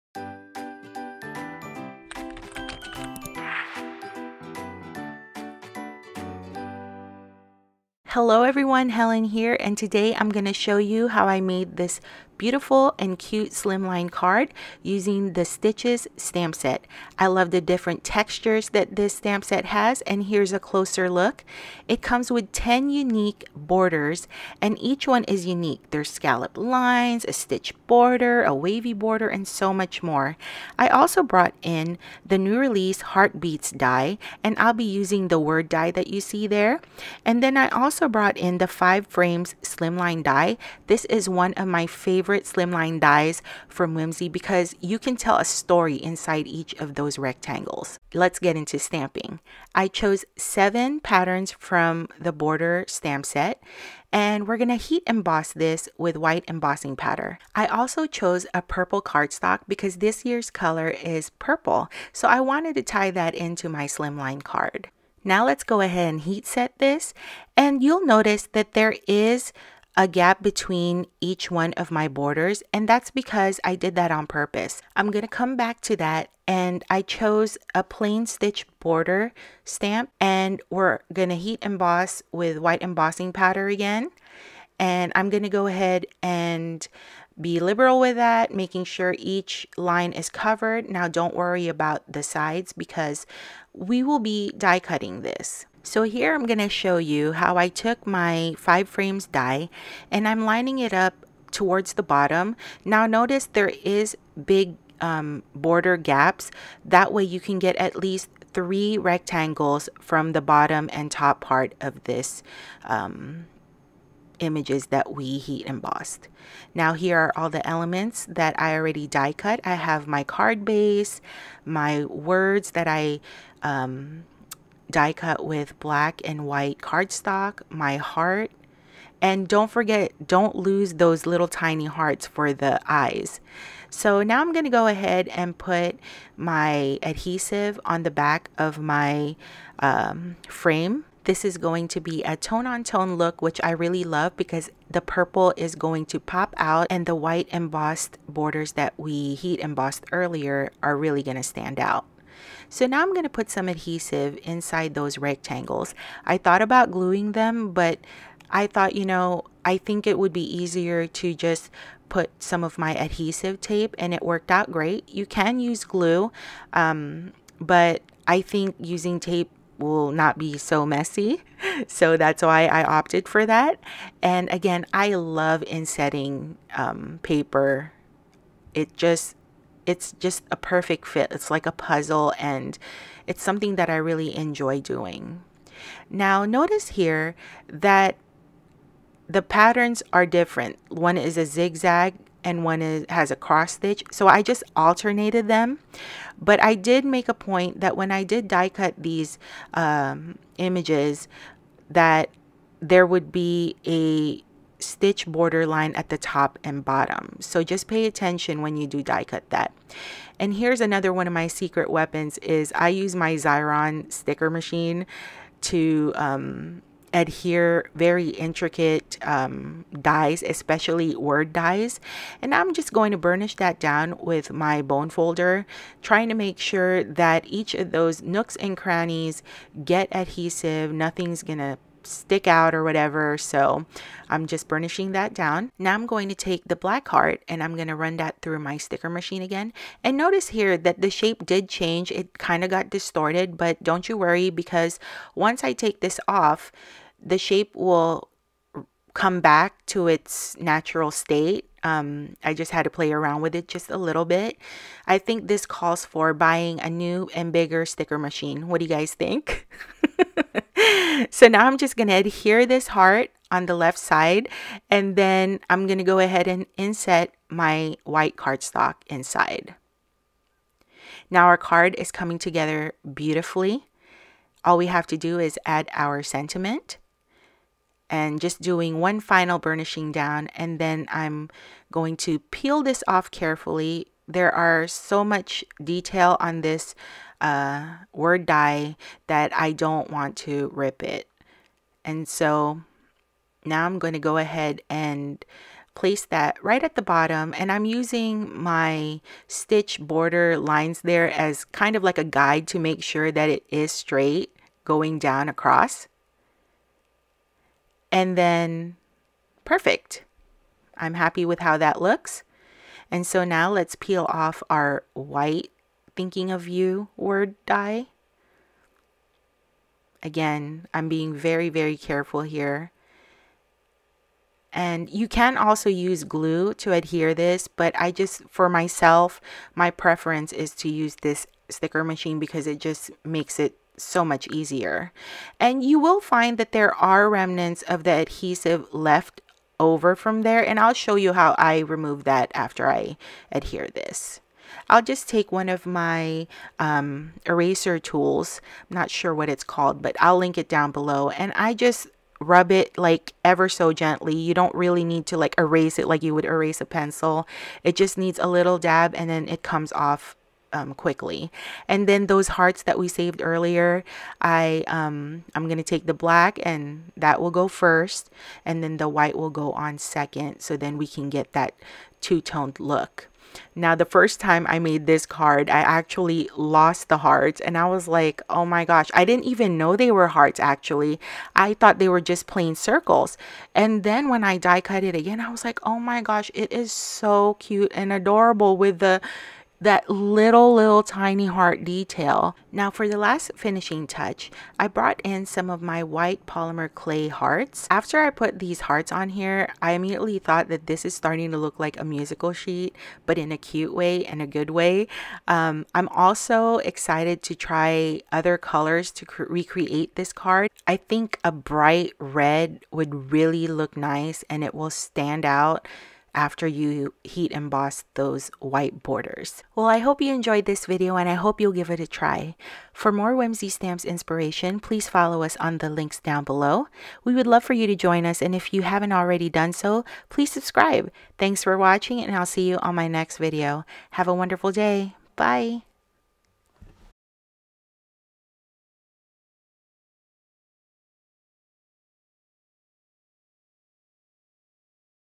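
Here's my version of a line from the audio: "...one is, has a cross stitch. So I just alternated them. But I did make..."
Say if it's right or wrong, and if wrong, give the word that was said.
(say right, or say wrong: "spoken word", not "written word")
right.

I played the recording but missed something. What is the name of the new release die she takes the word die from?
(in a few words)
Heartbeats.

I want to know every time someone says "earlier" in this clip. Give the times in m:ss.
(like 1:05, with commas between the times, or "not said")
2:30, 6:03.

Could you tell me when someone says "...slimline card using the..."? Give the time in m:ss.
0:13.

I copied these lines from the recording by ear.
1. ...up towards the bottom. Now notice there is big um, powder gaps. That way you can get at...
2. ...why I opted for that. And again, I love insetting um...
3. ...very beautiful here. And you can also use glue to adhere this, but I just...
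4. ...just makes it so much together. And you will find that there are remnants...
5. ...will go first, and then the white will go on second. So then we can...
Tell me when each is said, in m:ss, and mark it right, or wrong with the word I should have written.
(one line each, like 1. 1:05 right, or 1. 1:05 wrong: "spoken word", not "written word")
1. 1:40 wrong: "border", not "powder"
2. 2:52 right
3. 5:21 wrong: "careful", not "beautiful"
4. 5:32 wrong: "easier", not "together"
5. 6:07 right.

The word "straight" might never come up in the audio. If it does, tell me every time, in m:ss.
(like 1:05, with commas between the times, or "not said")
5:03.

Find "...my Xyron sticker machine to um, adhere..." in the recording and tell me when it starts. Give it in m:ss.
3:33.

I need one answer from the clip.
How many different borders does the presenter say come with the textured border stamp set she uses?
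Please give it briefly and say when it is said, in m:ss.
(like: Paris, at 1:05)
10, at 0:22.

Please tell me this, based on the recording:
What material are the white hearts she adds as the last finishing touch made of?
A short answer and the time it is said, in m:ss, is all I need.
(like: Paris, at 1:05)
Polymer clay, at 6:36.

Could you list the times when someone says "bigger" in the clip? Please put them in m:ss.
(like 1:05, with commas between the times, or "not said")
4:17.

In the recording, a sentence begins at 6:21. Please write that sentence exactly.
I thought they were just plain circles.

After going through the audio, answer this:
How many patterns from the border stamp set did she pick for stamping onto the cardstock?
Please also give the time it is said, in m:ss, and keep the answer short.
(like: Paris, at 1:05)
7, at 0:50.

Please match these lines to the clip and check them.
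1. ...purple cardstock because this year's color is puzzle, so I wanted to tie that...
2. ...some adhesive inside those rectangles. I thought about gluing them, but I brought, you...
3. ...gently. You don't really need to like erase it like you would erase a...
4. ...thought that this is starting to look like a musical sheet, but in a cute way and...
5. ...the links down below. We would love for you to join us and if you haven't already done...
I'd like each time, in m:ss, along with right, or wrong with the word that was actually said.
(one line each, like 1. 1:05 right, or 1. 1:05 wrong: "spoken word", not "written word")
1. 0:58 wrong: "purple", not "puzzle"
2. 2:33 wrong: "thought", not "brought"
3. 5:53 right
4. 6:40 right
5. 7:05 right.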